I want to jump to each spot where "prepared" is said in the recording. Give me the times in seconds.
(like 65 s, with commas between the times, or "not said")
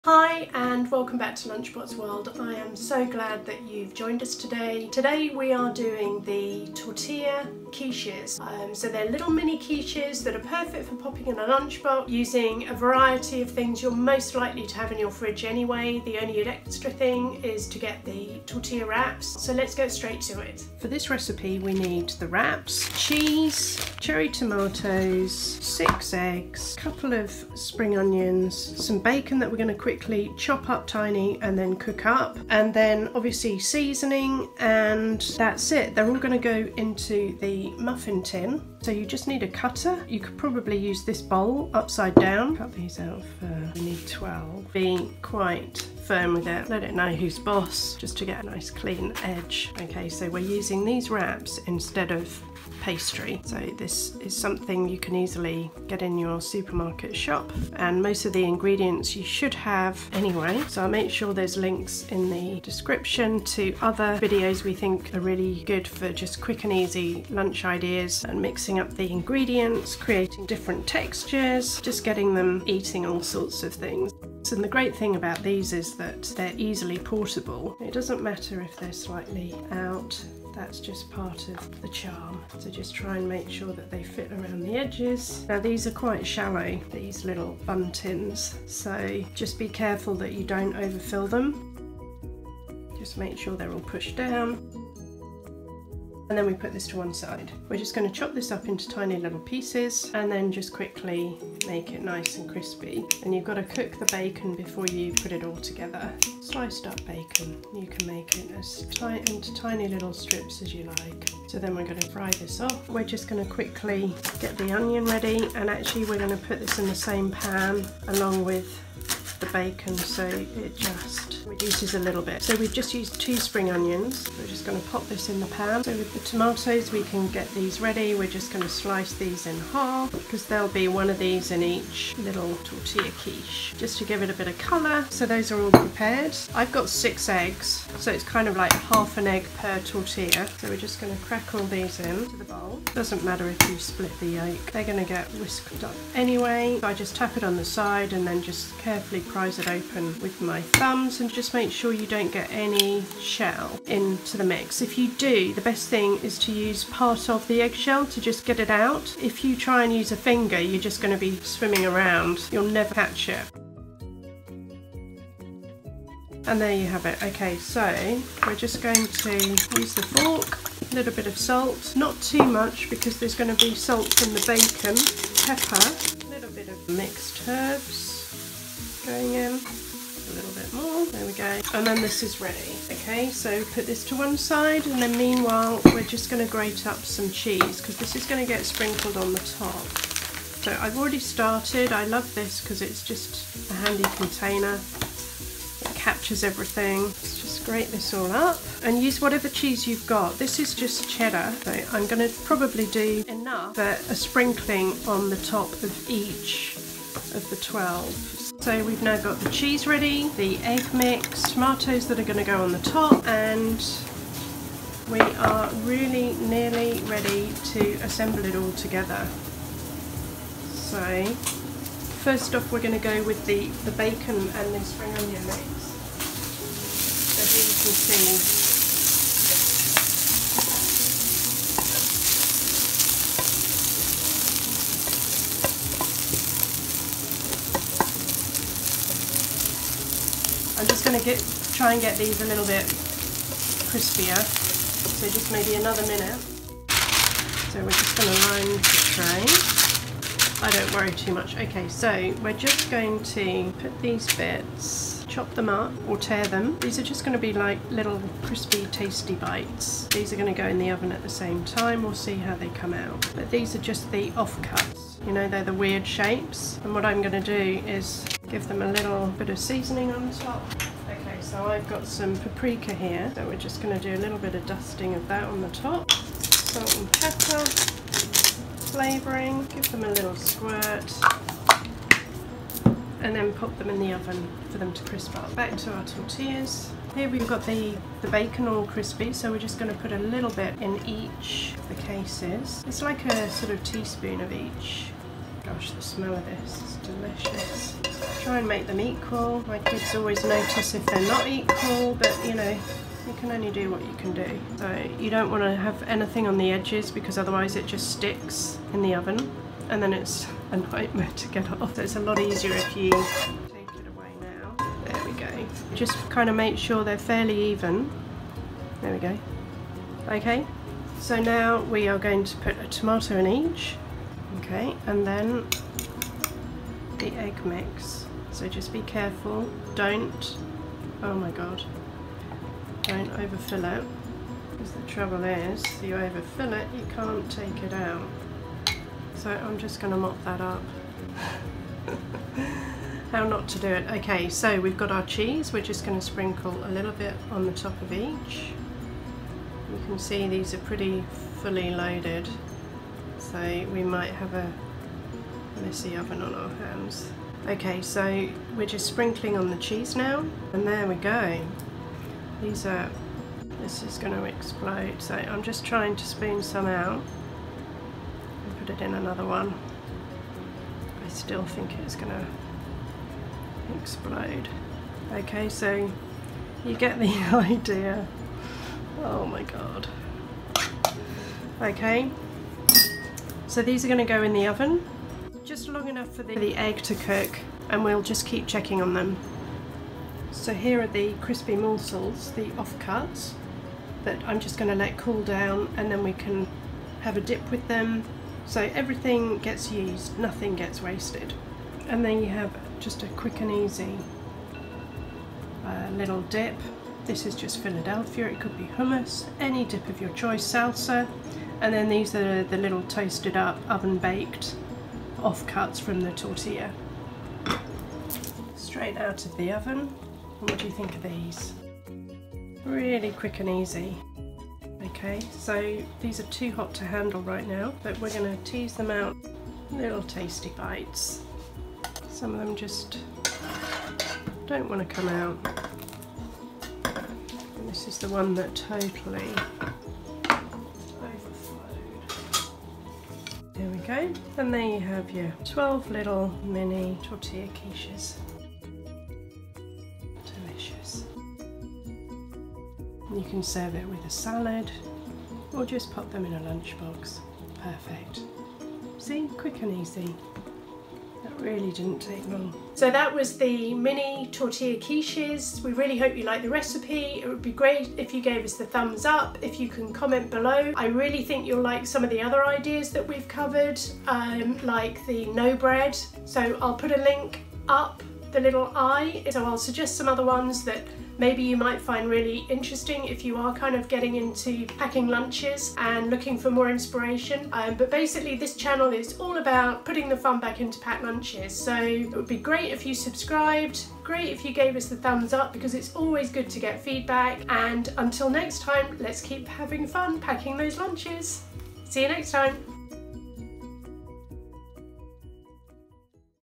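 135 s.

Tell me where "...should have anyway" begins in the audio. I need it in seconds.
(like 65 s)
59 s.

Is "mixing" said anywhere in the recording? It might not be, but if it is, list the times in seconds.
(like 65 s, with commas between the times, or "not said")
68 s.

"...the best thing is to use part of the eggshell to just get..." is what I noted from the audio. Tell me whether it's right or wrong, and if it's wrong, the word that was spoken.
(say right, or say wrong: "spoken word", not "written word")
right.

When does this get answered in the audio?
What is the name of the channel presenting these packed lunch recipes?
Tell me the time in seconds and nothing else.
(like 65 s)
1 s.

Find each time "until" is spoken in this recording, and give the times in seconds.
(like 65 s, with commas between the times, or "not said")
498 s.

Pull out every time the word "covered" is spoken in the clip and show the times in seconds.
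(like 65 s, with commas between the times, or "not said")
473 s.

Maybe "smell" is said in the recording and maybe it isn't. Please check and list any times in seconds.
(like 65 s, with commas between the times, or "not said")
296 s.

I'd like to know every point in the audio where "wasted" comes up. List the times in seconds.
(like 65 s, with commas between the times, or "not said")
401 s.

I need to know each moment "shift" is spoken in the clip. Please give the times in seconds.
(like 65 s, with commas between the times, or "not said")
not said.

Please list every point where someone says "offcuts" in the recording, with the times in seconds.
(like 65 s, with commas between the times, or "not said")
392 s, 415 s.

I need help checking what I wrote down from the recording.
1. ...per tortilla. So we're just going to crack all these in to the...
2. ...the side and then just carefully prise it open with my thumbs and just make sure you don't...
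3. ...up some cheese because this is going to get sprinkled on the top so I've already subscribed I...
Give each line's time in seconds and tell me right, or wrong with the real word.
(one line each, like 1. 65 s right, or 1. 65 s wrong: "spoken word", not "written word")
1. 139 s right
2. 147 s right
3. 186 s wrong: "started", not "subscribed".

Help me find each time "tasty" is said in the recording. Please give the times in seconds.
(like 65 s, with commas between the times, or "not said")
258 s, 430 s.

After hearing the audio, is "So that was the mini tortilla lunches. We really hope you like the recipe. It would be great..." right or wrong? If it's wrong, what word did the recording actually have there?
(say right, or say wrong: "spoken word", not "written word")
wrong: "quiches", not "lunches".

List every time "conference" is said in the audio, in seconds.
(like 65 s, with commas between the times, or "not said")
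not said.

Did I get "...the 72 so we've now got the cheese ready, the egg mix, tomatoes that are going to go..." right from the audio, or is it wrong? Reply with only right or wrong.
wrong.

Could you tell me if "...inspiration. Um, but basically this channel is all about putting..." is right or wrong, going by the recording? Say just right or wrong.
right.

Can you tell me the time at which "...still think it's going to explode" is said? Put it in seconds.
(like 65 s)
371 s.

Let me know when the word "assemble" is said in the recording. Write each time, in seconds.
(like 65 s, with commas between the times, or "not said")
218 s.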